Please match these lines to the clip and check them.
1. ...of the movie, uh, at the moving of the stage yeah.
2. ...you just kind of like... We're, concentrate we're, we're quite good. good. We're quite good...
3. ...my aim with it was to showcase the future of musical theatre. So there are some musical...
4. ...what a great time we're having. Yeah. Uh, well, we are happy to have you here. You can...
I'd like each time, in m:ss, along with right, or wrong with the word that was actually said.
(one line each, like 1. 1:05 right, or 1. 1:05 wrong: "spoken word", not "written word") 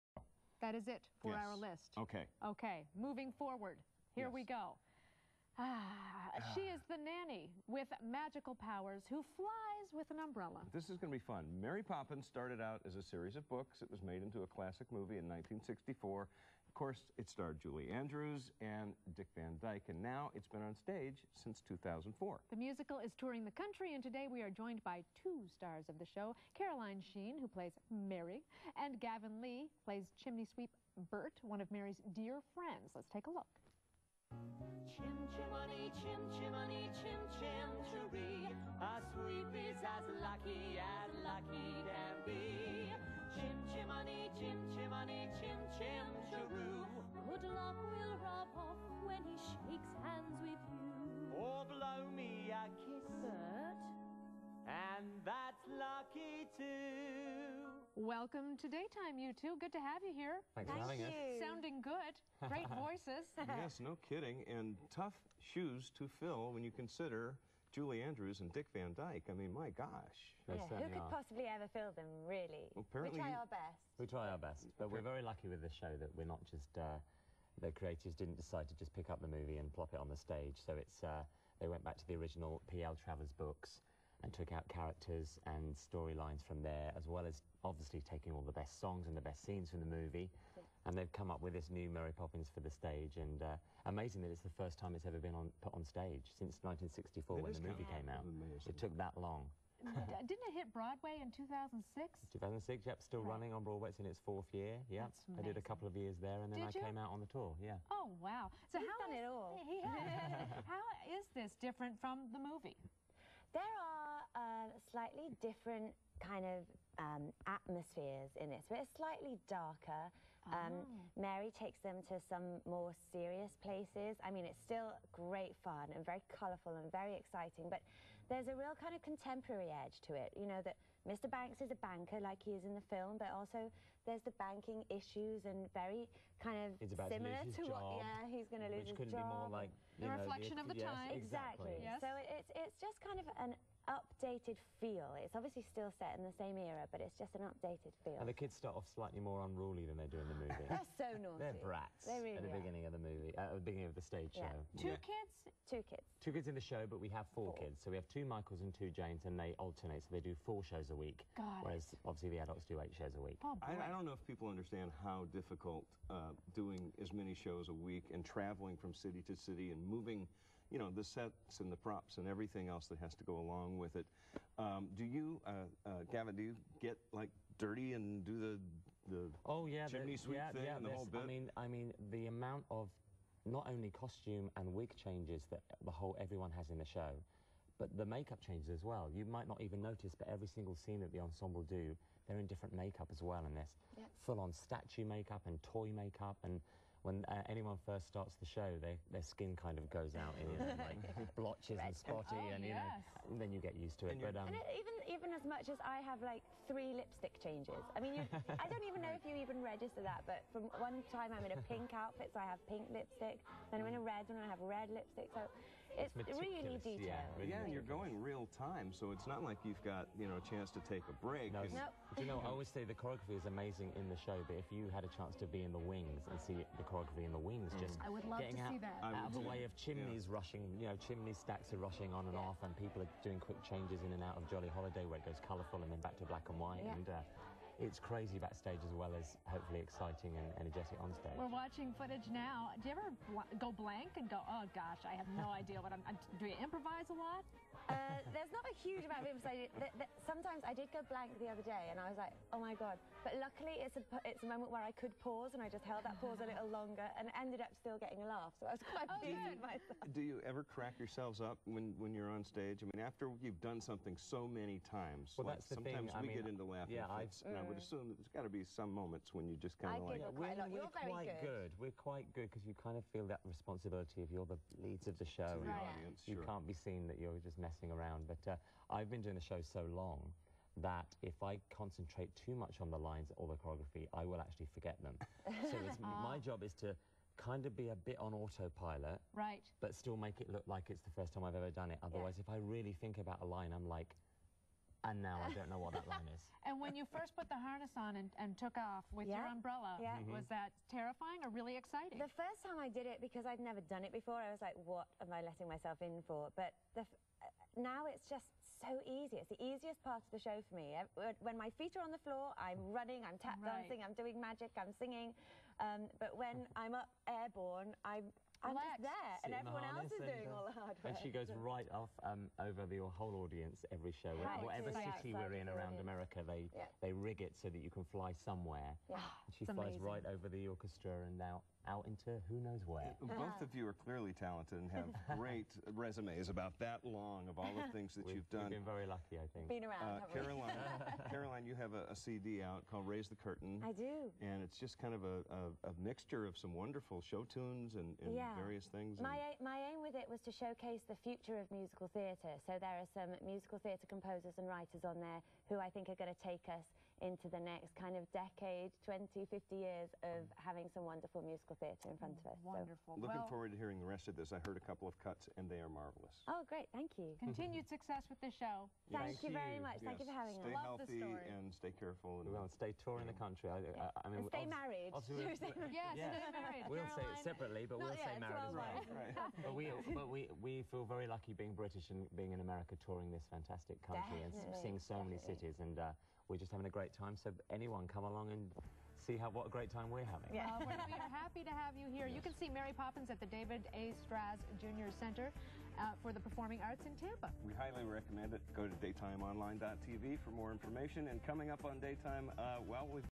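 1. 2:32 wrong: "beginning", not "moving"
2. 4:29 wrong: "quite", not "concentrate"
3. 5:49 right
4. 6:29 right.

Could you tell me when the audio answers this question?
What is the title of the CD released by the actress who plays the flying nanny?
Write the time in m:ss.
5:43.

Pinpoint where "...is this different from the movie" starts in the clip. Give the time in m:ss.
1:51.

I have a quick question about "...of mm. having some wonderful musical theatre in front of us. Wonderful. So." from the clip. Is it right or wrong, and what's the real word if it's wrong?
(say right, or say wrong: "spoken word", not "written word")
right.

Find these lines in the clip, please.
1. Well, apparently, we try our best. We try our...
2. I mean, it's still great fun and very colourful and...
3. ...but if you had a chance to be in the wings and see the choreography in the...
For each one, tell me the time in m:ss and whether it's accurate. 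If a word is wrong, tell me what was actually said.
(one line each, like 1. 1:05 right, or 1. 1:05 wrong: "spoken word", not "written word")
1. 1:12 right
2. 2:04 right
3. 3:44 right.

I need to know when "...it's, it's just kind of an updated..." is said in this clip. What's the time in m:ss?
2:22.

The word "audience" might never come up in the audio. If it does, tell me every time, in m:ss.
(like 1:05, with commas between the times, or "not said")
4:35, 5:23.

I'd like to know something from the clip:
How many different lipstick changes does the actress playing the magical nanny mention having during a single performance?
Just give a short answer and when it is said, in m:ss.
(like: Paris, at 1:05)
3, at 3:26.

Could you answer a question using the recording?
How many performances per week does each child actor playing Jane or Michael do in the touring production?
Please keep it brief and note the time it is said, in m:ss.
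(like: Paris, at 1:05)
4, at 2:40.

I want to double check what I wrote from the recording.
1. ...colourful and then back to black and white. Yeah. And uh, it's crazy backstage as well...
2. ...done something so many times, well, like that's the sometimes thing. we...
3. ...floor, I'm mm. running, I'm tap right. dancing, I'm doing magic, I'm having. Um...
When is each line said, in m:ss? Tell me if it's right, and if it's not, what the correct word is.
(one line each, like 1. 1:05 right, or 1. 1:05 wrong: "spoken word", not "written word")
1. 3:55 right
2. 4:23 right
3. 5:12 wrong: "singing", not "having".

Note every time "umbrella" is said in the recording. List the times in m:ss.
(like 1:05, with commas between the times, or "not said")
0:10, 4:59.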